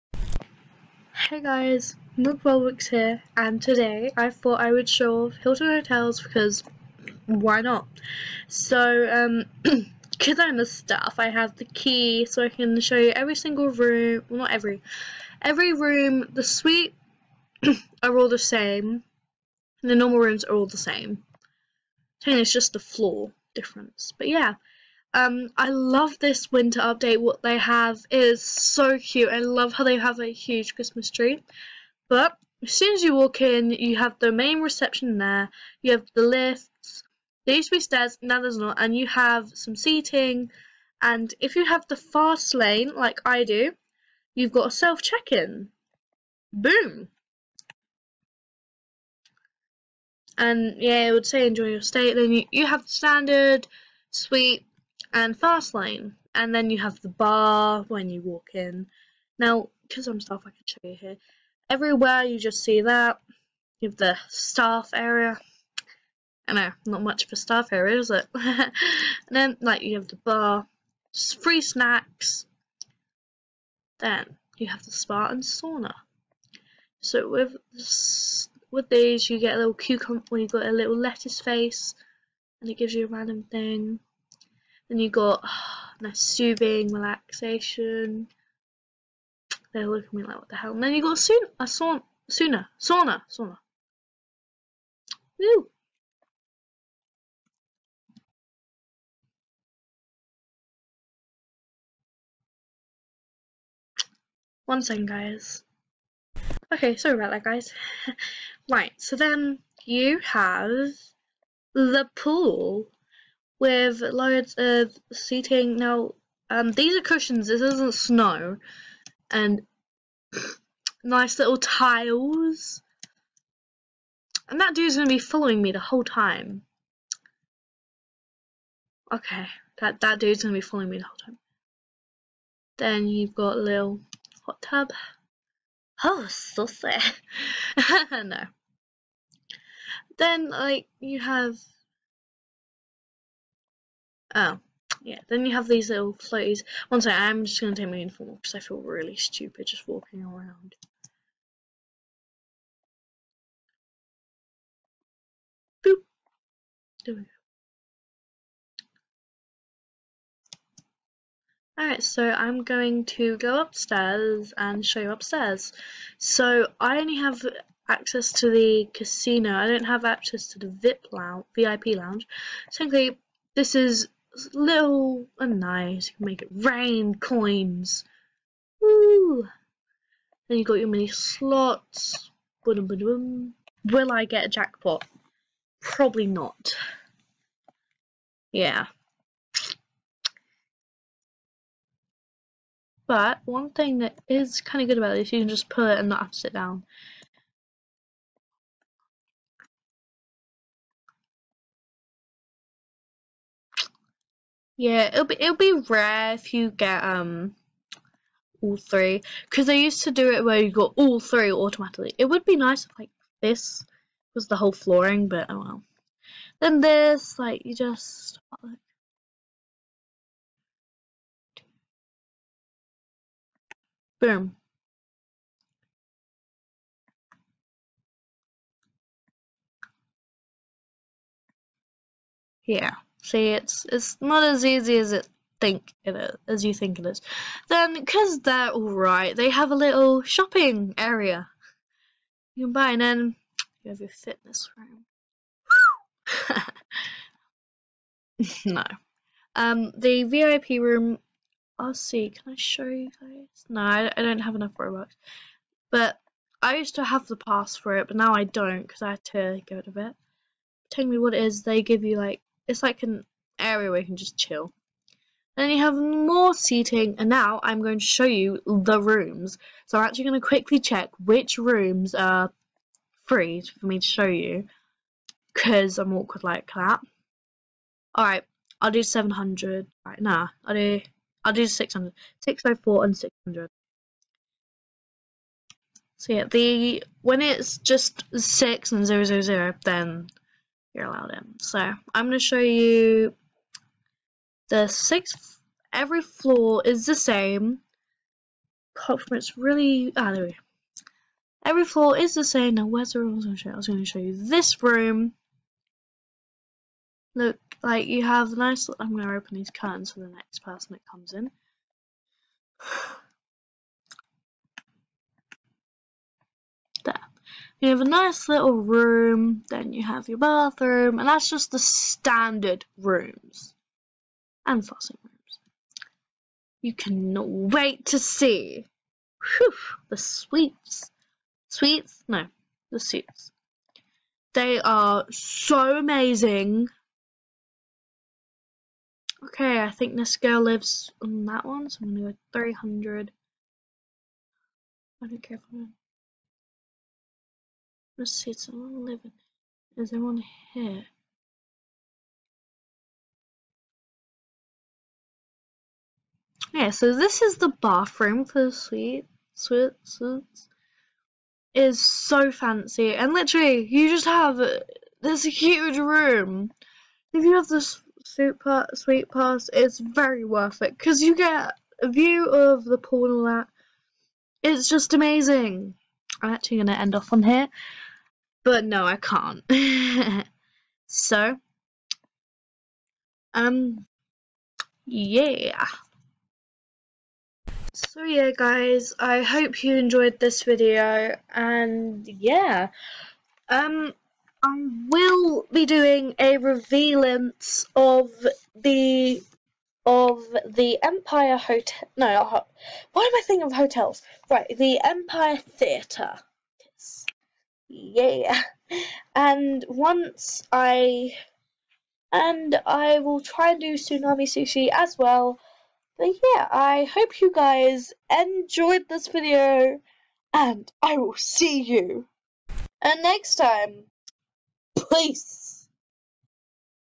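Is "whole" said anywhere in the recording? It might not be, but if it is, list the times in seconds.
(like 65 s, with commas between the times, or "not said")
125 s, 131 s, 214 s.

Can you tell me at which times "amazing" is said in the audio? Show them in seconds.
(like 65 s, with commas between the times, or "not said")
335 s, 375 s.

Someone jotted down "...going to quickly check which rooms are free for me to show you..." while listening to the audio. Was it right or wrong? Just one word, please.
right.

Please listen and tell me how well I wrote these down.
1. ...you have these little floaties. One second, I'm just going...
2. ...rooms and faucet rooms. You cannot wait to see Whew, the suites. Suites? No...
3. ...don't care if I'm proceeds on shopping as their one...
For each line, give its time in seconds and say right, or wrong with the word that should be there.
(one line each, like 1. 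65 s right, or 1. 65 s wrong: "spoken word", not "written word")
1. 145 s right
2. 322 s right
3. 345 s wrong: "living", not "shopping".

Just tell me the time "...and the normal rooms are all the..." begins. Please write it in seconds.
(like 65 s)
19 s.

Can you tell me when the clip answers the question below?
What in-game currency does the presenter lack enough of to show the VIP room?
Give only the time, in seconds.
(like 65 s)
254 s.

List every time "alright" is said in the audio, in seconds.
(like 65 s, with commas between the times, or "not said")
161 s, 238 s, 278 s.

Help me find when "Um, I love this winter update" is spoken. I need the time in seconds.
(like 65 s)
25 s.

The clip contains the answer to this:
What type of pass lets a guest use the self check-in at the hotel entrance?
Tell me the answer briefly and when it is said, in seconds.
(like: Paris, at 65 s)
Fast lane, at 41 s.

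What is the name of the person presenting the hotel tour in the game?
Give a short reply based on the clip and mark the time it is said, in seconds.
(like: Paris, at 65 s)
Nook, at 2 s.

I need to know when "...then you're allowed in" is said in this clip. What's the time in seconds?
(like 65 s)
289 s.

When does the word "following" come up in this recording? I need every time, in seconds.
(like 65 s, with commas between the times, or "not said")
125 s, 130 s.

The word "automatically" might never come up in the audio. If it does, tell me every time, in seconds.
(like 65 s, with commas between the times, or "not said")
211 s.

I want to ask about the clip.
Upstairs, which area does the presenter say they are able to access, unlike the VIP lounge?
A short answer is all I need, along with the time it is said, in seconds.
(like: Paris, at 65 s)
The casino, at 168 s.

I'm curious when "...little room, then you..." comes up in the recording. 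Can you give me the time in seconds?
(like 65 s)
318 s.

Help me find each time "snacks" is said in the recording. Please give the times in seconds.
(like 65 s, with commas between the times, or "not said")
71 s.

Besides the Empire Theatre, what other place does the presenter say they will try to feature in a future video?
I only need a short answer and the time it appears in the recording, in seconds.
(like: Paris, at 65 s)
Tsunami Sushi, at 413 s.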